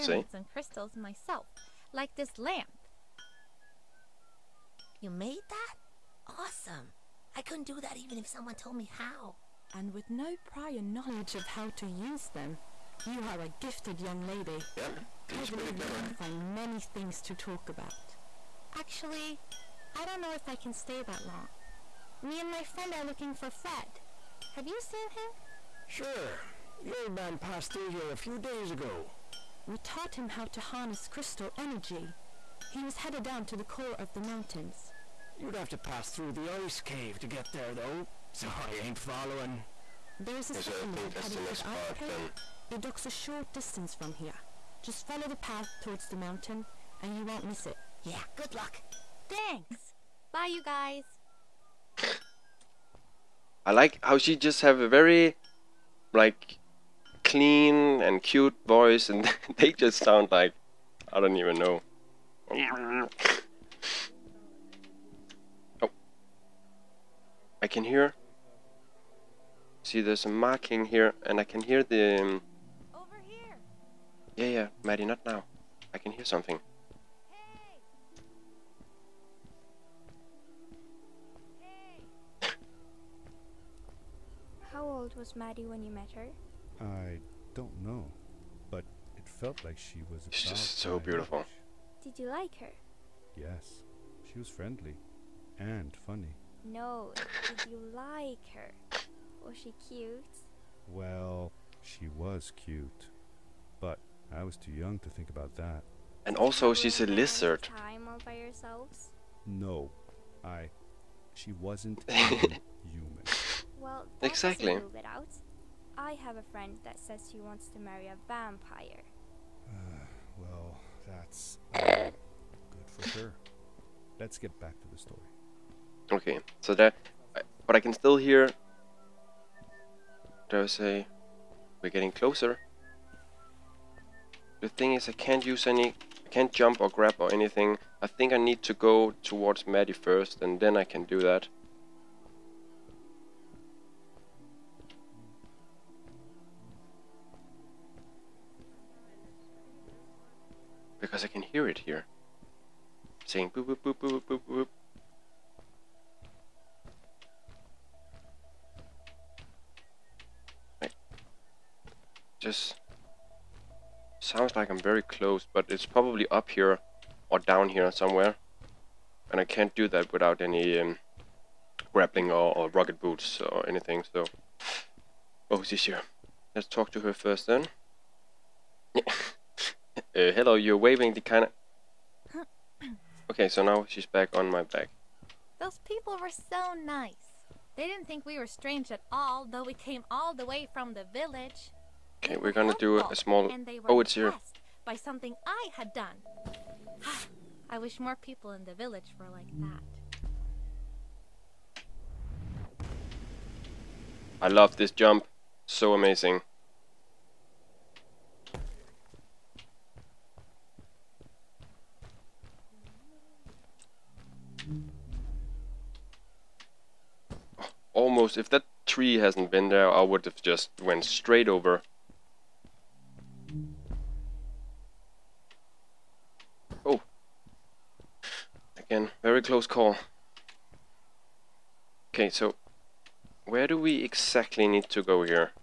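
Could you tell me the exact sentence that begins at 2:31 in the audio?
because I can hear it here.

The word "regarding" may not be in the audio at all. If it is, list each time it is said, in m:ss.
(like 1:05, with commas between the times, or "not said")
not said.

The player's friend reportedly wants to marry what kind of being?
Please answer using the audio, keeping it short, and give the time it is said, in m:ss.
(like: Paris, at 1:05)
a vampire, at 1:58.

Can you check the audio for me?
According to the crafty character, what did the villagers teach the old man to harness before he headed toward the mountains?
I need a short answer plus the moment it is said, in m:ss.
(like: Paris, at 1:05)
crystal energy, at 0:31.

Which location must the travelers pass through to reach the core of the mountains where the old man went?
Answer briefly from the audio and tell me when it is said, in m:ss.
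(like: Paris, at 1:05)
the ice cave, at 0:36.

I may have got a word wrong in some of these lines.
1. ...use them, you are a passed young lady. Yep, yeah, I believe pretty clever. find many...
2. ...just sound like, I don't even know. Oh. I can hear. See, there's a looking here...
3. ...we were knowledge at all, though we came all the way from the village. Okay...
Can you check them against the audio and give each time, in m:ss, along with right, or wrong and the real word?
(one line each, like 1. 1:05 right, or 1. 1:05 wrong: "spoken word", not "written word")
1. 0:11 wrong: "gifted", not "passed"
2. 0:59 wrong: "marking", not "looking"
3. 3:08 wrong: "strange", not "knowledge".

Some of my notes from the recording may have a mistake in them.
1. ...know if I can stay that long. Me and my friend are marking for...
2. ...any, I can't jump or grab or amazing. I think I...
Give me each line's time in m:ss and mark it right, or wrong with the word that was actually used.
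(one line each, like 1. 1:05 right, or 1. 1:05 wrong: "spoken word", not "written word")
1. 0:20 wrong: "looking", not "marking"
2. 2:15 wrong: "anything", not "amazing".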